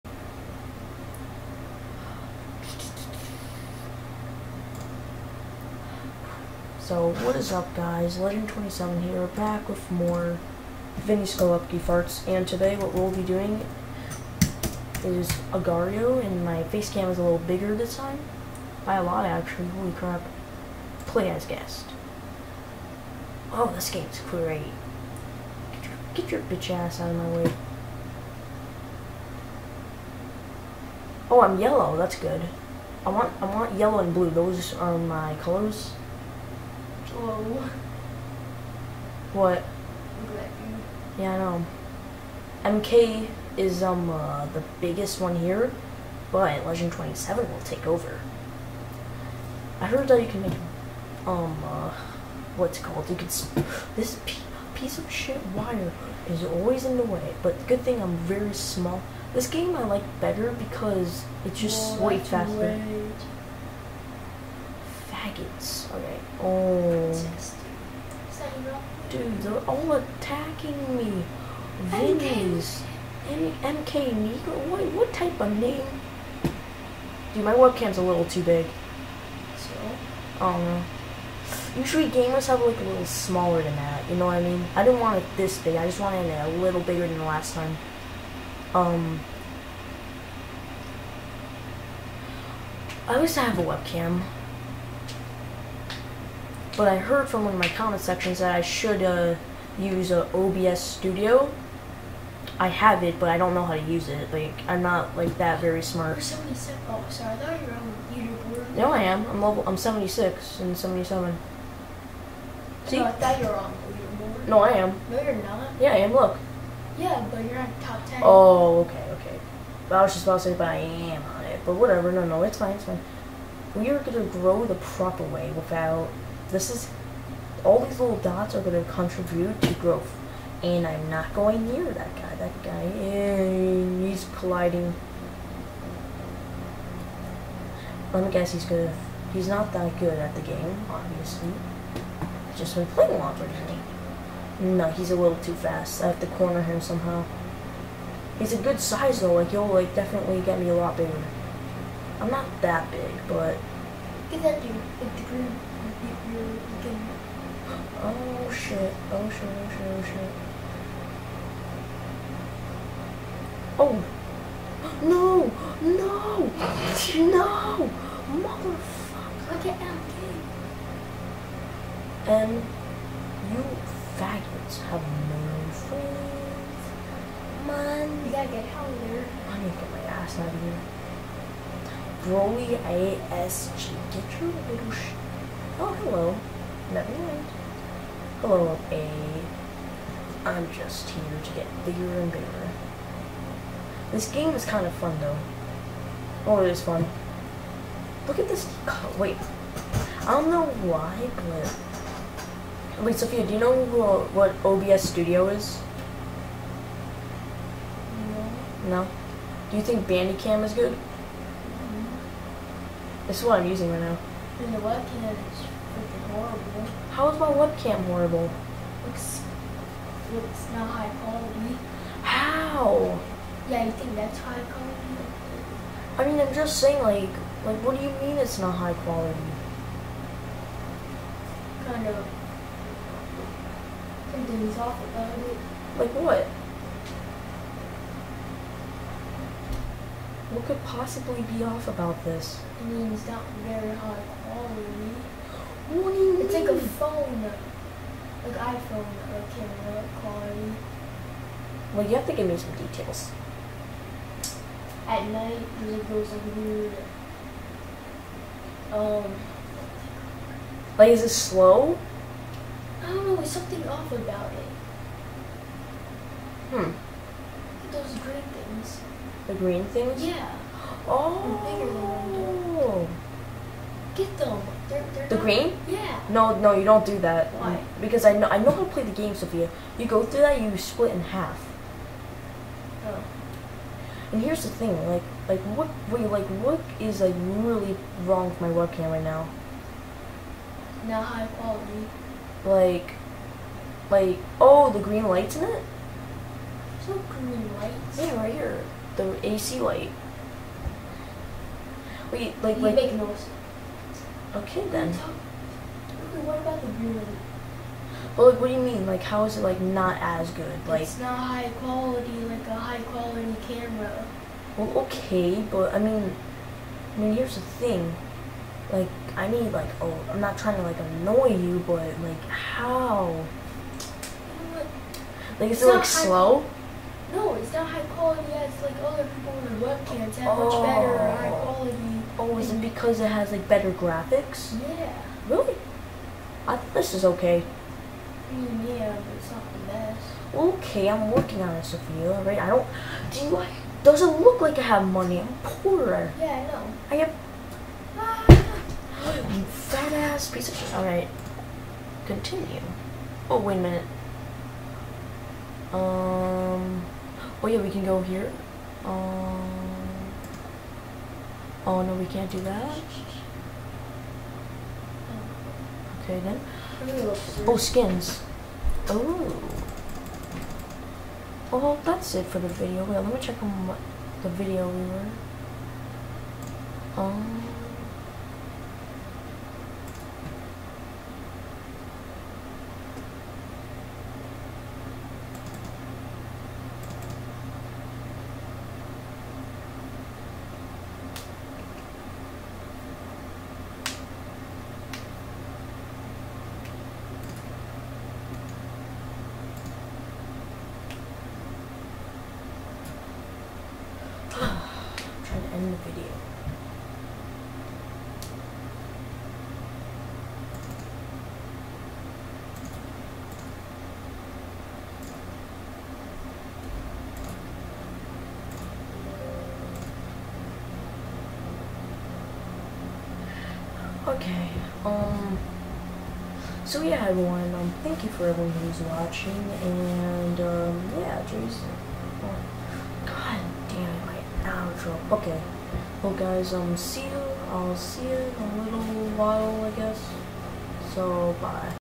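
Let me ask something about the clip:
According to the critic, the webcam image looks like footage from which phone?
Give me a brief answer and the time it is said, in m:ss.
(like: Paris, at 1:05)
iPhone, at 4:08.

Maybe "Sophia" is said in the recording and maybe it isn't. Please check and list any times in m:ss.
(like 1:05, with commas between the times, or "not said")
3:23, 4:39, 5:41.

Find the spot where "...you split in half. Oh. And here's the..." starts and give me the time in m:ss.
4:40.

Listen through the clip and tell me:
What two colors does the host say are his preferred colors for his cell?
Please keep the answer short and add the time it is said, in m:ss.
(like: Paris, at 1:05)
yellow and blue, at 0:33.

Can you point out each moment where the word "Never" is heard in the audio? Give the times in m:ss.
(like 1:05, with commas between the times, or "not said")
3:06.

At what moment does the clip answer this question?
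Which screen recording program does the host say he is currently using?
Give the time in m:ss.
3:30.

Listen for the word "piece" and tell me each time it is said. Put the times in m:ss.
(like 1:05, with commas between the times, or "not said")
0:54, 5:50.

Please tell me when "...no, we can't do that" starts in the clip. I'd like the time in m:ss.
6:02.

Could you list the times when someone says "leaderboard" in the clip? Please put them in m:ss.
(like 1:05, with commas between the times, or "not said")
1:48, 1:53.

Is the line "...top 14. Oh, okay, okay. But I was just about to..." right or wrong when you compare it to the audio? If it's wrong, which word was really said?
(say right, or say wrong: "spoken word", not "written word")
wrong: "10", not "14".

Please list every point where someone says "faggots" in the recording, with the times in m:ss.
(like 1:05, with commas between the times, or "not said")
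2:54.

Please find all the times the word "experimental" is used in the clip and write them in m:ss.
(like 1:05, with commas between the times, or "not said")
not said.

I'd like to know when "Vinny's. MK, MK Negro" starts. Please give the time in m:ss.
1:11.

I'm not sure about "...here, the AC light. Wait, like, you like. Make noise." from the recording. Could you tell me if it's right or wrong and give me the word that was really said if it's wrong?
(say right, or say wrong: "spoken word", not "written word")
right.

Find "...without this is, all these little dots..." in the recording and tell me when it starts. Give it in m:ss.
2:05.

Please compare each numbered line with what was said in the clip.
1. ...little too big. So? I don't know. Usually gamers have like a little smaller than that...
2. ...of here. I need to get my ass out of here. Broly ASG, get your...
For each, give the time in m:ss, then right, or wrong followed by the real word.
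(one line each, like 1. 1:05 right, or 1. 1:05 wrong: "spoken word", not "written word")
1. 1:18 right
2. 2:58 right.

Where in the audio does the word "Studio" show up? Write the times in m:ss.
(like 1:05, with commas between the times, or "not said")
1:40, 3:25.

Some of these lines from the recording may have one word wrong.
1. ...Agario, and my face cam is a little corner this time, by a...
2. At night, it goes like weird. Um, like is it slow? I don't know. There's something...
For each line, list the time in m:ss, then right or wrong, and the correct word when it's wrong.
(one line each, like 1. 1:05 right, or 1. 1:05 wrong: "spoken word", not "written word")
1. 0:15 wrong: "bigger", not "corner"
2. 4:15 right.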